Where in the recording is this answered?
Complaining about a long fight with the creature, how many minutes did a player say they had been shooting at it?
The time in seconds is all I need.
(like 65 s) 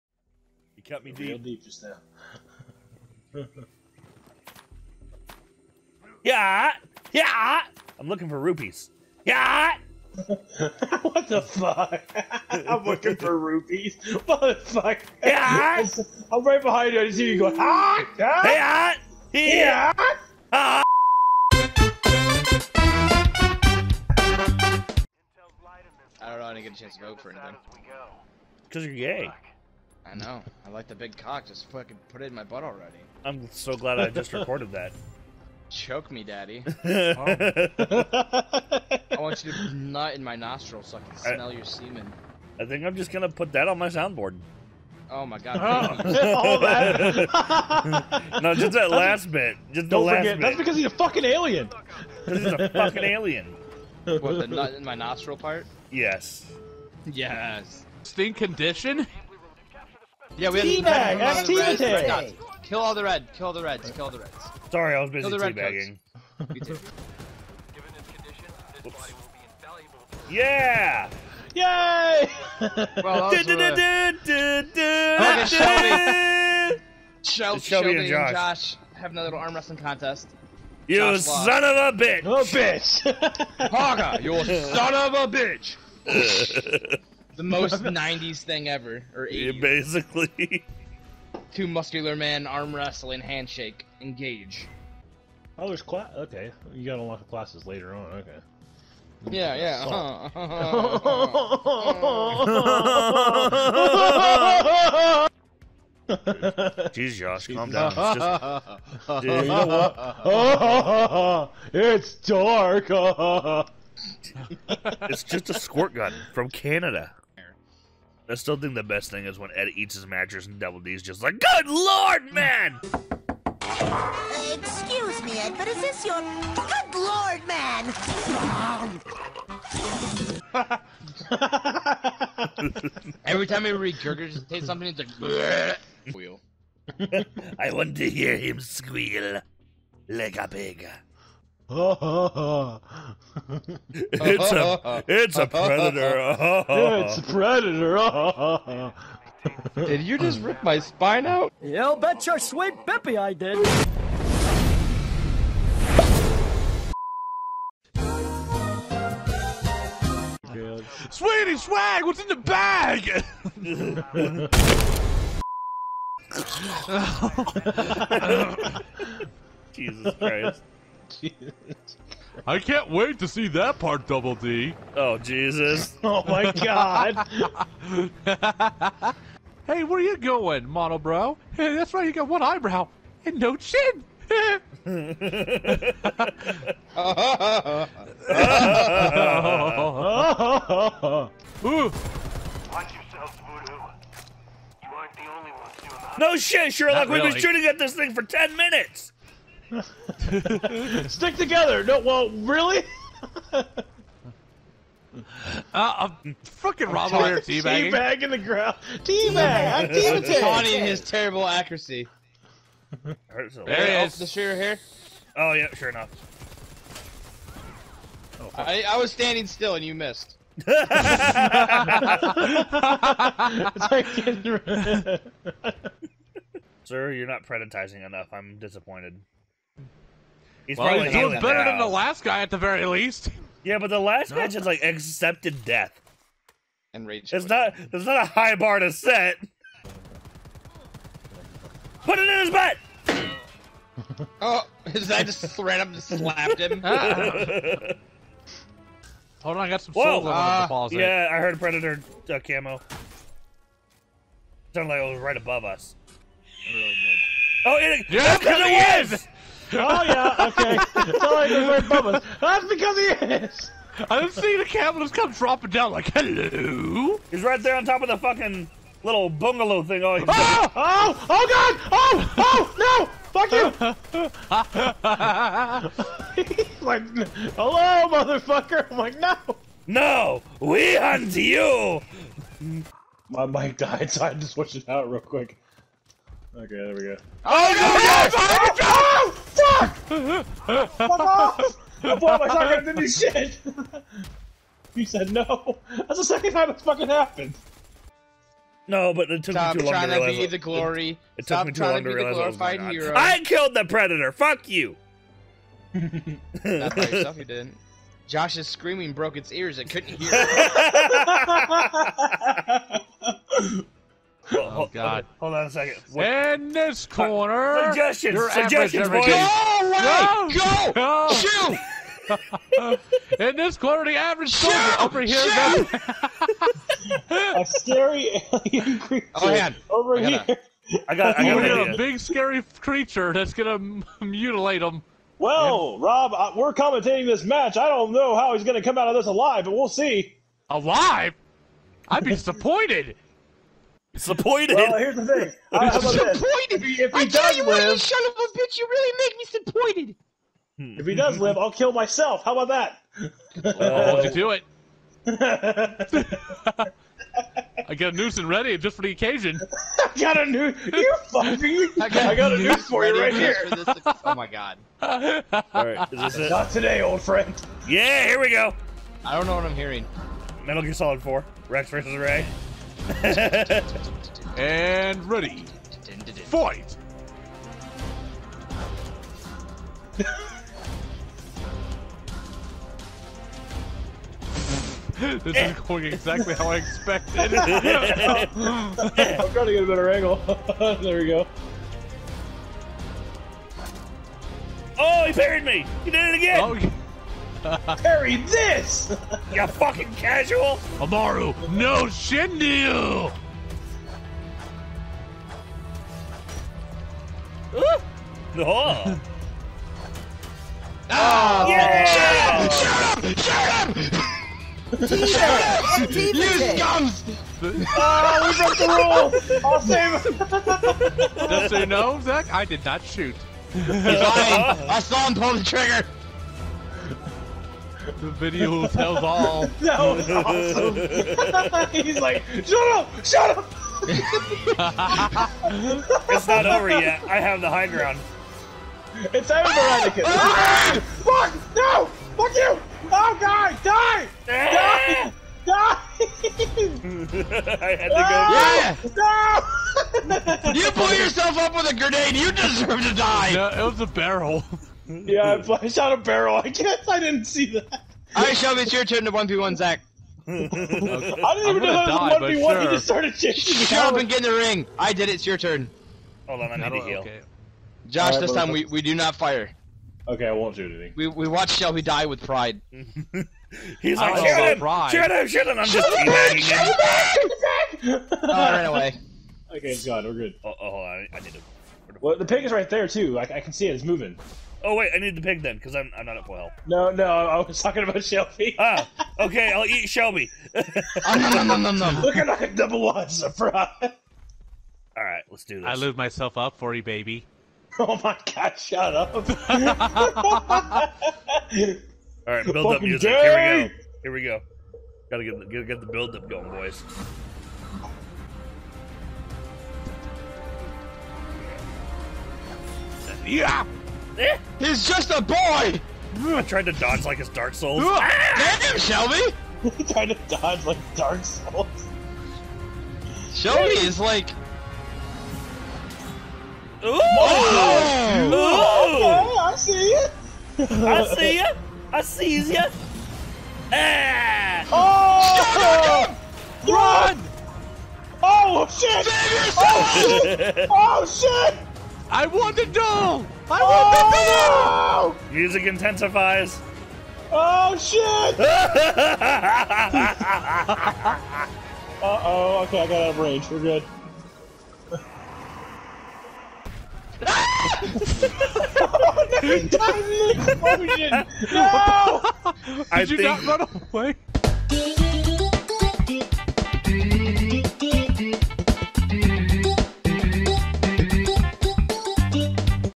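198 s.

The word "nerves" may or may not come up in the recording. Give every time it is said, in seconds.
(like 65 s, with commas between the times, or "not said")
not said.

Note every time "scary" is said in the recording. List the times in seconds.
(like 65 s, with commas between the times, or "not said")
327 s, 332 s.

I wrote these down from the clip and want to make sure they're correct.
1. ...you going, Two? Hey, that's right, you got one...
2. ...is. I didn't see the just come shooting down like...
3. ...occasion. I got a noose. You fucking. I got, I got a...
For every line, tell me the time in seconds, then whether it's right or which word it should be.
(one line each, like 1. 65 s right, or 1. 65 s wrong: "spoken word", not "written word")
1. 179 s wrong: "Monobrow", not "Two"
2. 263 s wrong: "dropping", not "shooting"
3. 359 s right.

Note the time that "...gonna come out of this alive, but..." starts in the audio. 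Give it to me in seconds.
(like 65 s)
338 s.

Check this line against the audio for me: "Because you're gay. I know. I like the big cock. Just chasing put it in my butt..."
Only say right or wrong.
wrong.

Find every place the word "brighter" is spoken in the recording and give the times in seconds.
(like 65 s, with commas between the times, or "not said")
not said.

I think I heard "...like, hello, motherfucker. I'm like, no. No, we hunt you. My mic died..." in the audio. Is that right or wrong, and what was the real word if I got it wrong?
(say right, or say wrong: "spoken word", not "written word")
right.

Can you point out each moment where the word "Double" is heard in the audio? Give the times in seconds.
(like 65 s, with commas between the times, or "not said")
120 s, 174 s.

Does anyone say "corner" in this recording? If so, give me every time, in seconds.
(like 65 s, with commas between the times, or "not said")
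317 s, 323 s.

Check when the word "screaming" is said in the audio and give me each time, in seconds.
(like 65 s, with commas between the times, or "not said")
308 s.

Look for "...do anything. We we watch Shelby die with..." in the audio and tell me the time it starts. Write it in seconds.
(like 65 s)
470 s.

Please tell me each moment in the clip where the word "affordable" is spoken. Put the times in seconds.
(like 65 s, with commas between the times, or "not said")
not said.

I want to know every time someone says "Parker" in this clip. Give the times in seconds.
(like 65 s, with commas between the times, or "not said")
83 s.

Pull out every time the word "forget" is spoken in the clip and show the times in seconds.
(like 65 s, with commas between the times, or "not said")
50 s.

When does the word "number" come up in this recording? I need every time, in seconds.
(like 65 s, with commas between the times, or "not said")
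492 s.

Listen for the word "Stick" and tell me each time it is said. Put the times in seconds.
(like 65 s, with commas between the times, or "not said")
201 s.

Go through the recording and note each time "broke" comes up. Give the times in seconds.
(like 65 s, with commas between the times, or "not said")
309 s, 418 s.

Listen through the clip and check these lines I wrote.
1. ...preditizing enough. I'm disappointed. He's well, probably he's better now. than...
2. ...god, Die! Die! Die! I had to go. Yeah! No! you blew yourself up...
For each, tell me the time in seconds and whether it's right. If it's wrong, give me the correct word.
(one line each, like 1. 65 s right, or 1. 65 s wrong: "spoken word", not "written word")
1. 227 s right
2. 443 s right.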